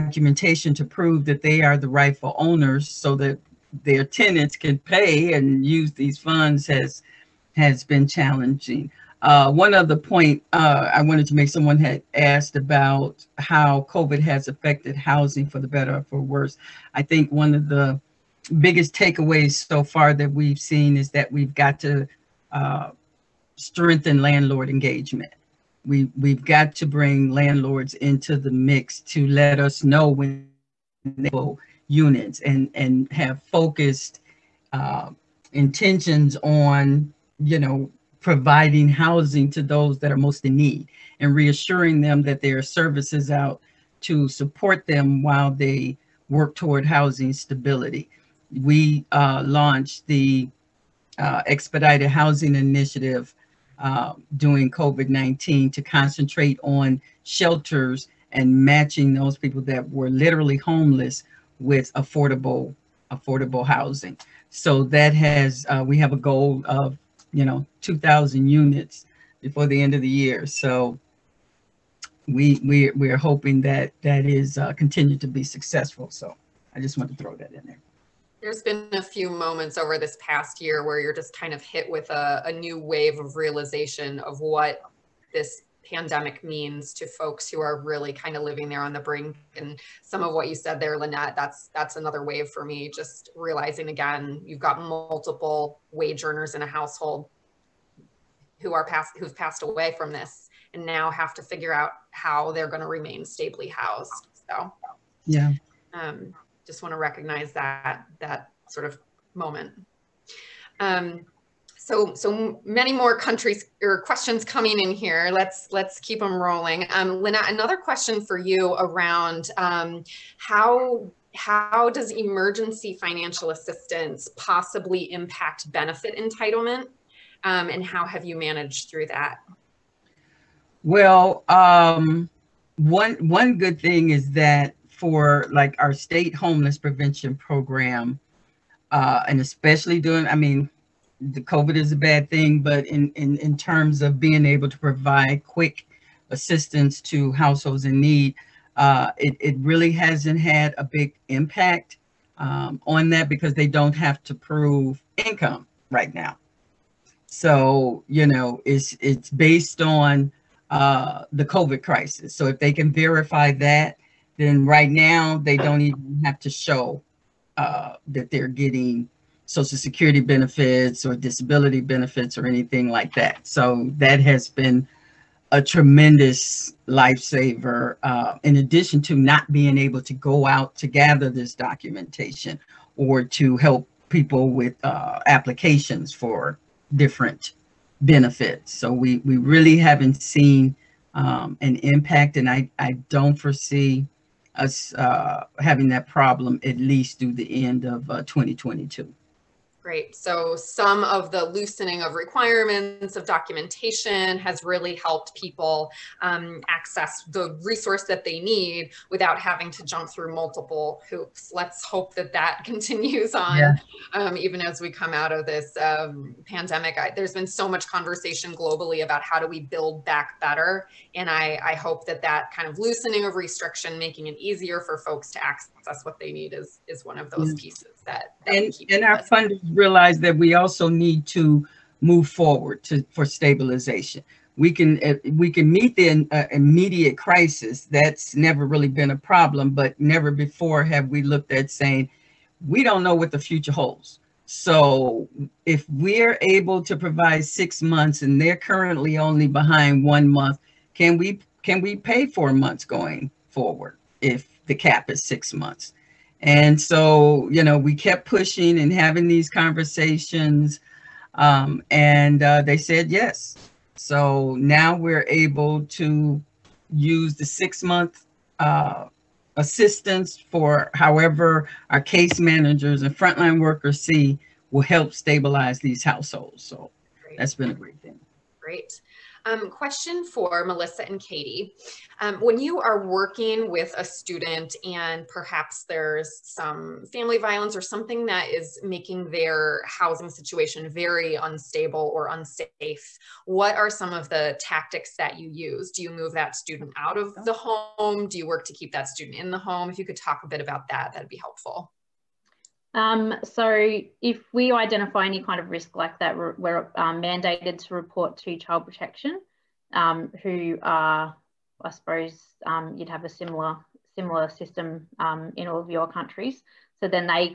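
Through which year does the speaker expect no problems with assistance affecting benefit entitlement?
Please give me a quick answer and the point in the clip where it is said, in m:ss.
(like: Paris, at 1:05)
2022, at 3:18.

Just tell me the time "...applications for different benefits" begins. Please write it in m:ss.
3:05.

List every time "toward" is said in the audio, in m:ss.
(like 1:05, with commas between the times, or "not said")
0:46.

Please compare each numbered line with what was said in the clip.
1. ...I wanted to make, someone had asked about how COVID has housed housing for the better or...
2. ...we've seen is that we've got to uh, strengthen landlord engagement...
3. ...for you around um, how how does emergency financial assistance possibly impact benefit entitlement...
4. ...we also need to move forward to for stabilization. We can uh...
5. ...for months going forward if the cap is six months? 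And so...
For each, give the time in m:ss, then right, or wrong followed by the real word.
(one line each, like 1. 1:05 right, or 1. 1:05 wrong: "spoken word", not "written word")
1. 0:10 wrong: "affected", not "housed"
2. 0:20 right
3. 1:58 right
4. 3:50 right
5. 4:12 right.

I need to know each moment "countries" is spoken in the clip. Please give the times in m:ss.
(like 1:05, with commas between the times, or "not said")
1:53, 5:16.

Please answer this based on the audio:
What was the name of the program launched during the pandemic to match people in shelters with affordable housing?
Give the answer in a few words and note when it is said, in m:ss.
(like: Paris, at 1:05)
Expedited Housing Initiative, at 0:51.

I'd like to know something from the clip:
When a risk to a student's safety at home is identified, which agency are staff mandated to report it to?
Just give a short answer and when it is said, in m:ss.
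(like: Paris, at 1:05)
child protection, at 5:08.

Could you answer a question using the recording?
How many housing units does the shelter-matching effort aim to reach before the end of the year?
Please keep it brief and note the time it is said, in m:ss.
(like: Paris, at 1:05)
2,000, at 1:07.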